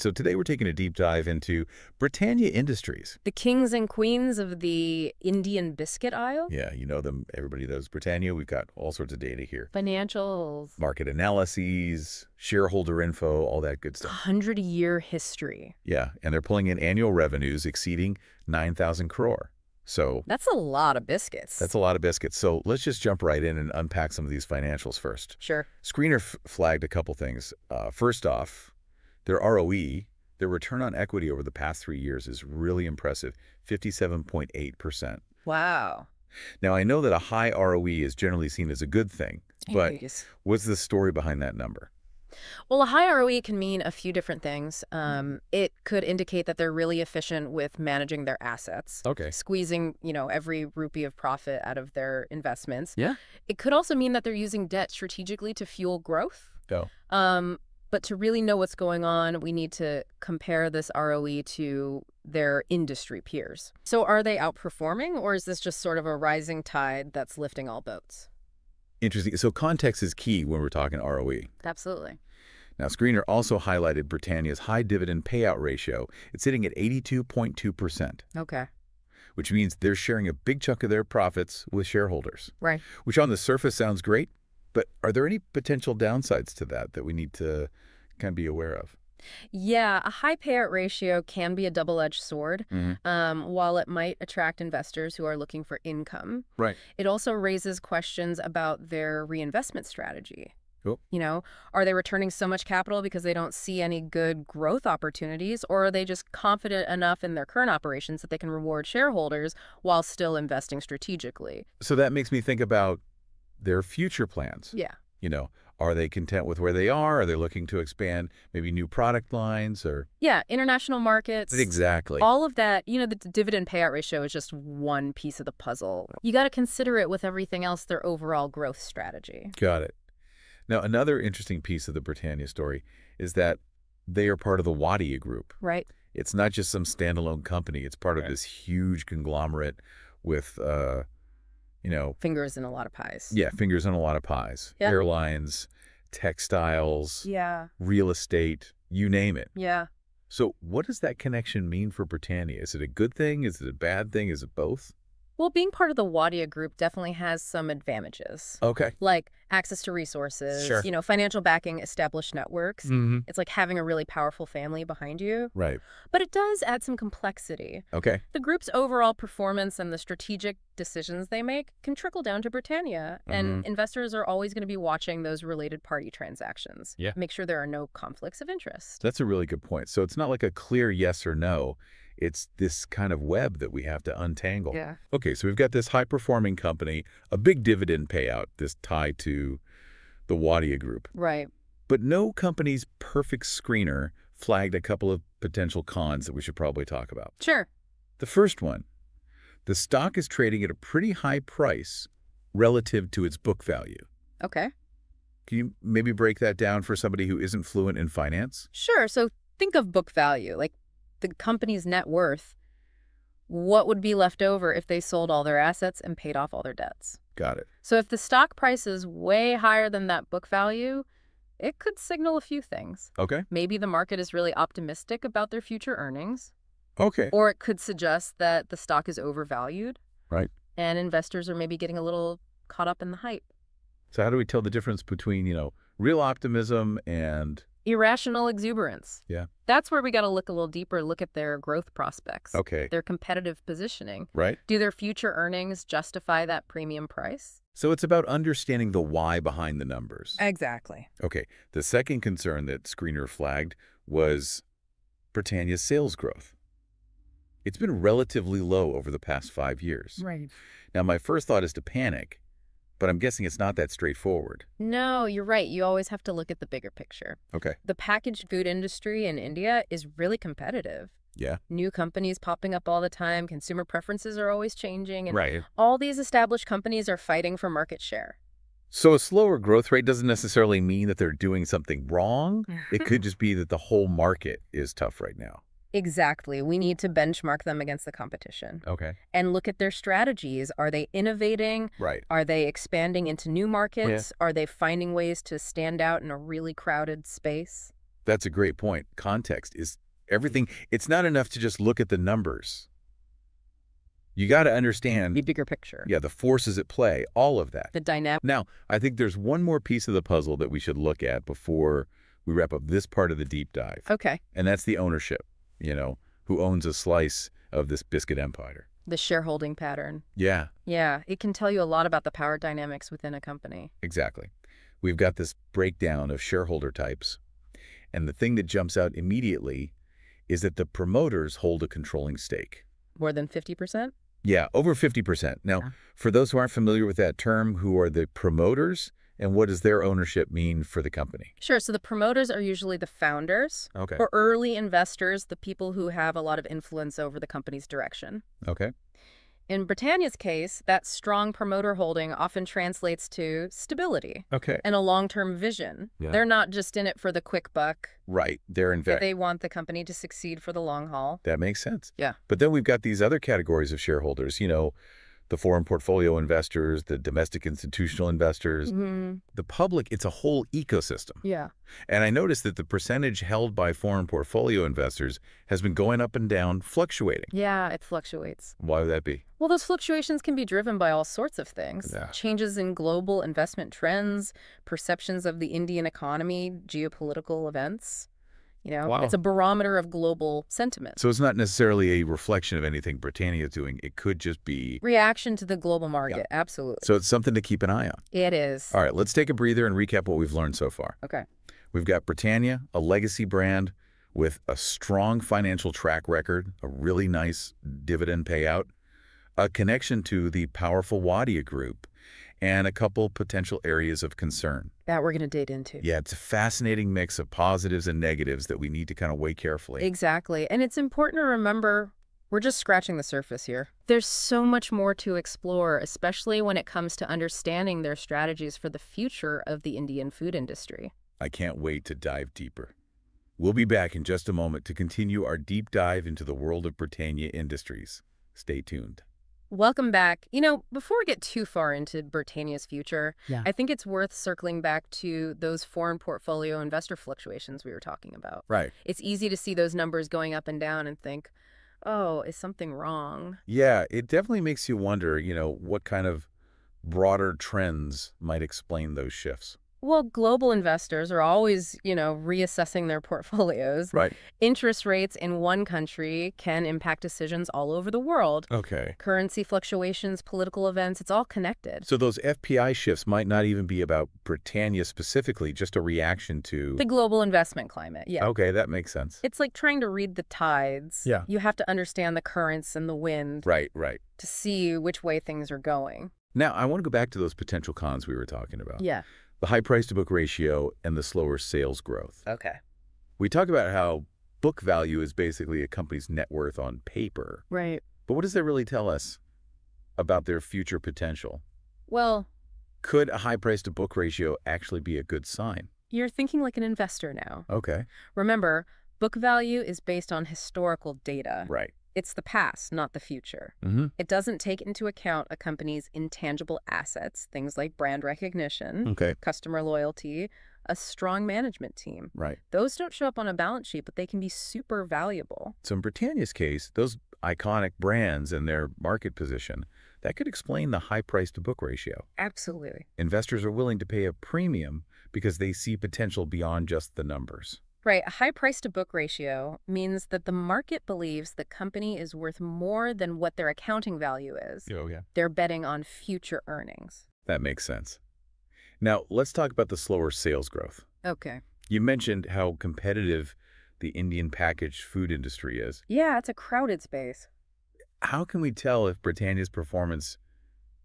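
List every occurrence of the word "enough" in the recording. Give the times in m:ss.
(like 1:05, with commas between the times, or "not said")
1:46, 5:01.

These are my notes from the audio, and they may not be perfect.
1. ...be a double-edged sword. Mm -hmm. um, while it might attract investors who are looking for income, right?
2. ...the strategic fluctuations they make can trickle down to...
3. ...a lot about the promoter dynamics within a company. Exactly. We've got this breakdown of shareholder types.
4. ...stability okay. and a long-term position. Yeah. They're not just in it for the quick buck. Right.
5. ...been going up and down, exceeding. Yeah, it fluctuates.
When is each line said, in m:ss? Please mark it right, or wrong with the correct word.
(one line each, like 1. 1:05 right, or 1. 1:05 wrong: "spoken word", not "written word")
1. 1:31 right
2. 2:49 wrong: "decisions", not "fluctuations"
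3. 5:21 wrong: "power", not "promoter"
4. 5:53 wrong: "vision", not "position"
5. 6:15 wrong: "fluctuating", not "exceeding".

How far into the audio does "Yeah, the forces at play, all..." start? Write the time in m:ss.
5:06.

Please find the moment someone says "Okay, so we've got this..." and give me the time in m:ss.
3:05.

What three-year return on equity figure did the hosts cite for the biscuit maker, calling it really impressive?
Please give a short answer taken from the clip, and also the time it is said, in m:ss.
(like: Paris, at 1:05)
57.8%, at 0:33.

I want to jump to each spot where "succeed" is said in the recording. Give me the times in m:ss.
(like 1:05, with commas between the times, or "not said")
6:00.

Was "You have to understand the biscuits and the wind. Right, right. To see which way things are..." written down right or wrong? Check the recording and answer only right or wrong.
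wrong.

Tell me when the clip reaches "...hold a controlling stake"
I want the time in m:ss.
5:31.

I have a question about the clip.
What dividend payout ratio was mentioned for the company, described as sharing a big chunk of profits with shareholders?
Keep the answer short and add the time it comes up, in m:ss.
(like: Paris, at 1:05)
82.2%, at 1:16.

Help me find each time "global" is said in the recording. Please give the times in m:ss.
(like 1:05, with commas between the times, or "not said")
6:23, 6:30, 6:35, 7:40, 7:57.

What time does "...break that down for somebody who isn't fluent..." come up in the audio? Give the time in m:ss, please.
3:26.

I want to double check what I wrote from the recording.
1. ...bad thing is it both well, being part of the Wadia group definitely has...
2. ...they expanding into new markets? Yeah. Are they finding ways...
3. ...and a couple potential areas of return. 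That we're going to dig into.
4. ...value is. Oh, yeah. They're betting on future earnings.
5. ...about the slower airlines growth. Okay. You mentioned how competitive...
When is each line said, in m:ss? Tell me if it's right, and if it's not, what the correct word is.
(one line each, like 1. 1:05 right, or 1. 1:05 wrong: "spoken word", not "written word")
1. 2:33 right
2. 4:52 right
3. 6:52 wrong: "concern", not "return"
4. 9:04 right
5. 9:09 wrong: "sales", not "airlines".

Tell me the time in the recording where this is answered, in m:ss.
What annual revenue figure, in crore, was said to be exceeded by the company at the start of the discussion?
0:18.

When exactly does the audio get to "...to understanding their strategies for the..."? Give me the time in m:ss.
7:07.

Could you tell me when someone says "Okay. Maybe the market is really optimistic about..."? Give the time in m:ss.
3:43.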